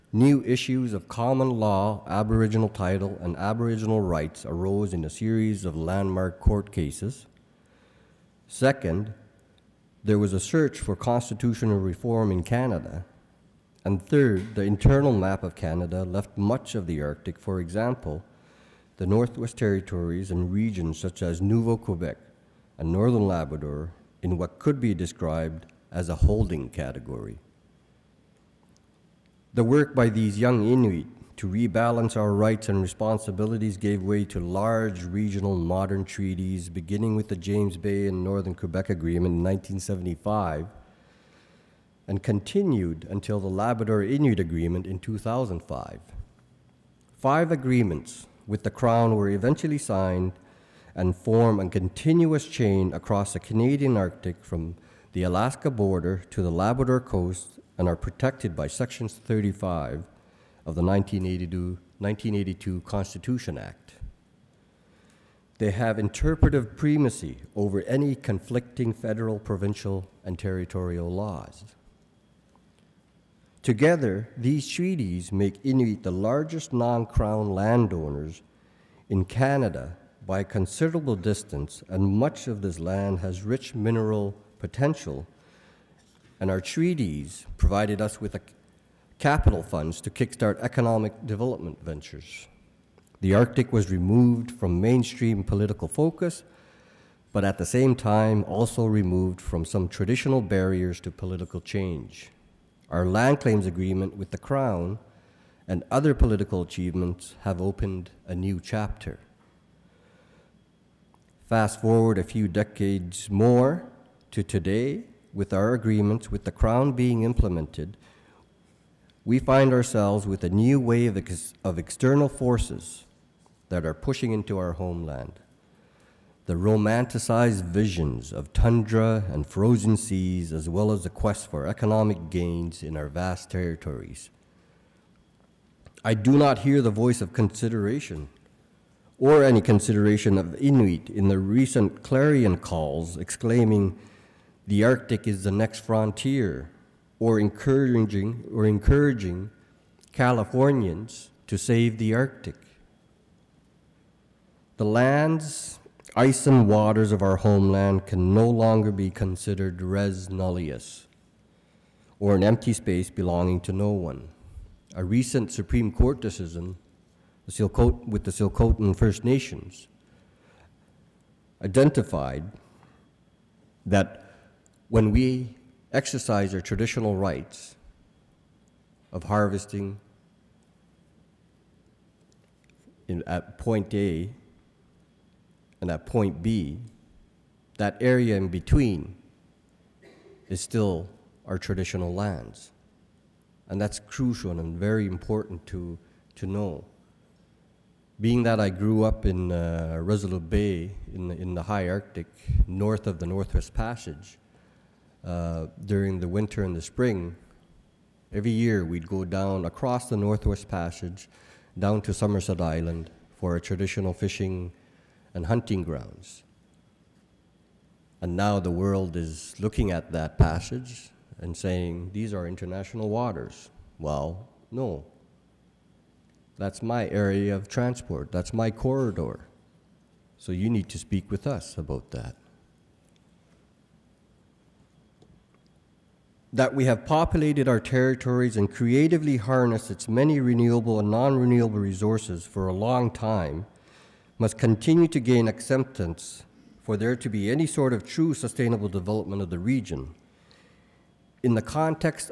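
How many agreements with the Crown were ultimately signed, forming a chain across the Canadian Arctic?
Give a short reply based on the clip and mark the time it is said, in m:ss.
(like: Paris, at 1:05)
5, at 0:47.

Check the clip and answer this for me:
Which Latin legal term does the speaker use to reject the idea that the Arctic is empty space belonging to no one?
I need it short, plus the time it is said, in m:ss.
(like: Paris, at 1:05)
res nullius, at 2:39.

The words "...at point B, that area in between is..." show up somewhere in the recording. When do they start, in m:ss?
3:05.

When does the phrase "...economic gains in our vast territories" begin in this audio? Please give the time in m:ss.
2:11.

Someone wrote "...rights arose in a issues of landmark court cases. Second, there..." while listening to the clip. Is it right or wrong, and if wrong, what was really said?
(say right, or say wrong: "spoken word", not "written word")
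wrong: "series", not "issues".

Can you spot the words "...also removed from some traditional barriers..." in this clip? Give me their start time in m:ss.
1:38.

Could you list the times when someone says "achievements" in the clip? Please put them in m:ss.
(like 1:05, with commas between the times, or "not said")
1:46.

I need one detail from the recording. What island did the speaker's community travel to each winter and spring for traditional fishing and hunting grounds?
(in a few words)
Somerset Island.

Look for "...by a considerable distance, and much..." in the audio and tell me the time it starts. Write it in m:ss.
1:20.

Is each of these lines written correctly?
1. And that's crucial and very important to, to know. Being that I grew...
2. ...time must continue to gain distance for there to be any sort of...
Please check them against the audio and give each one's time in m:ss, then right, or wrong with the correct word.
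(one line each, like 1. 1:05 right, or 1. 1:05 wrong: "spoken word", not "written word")
1. 3:13 right
2. 4:03 wrong: "acceptance", not "distance".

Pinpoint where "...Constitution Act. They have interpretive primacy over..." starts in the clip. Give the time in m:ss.
1:02.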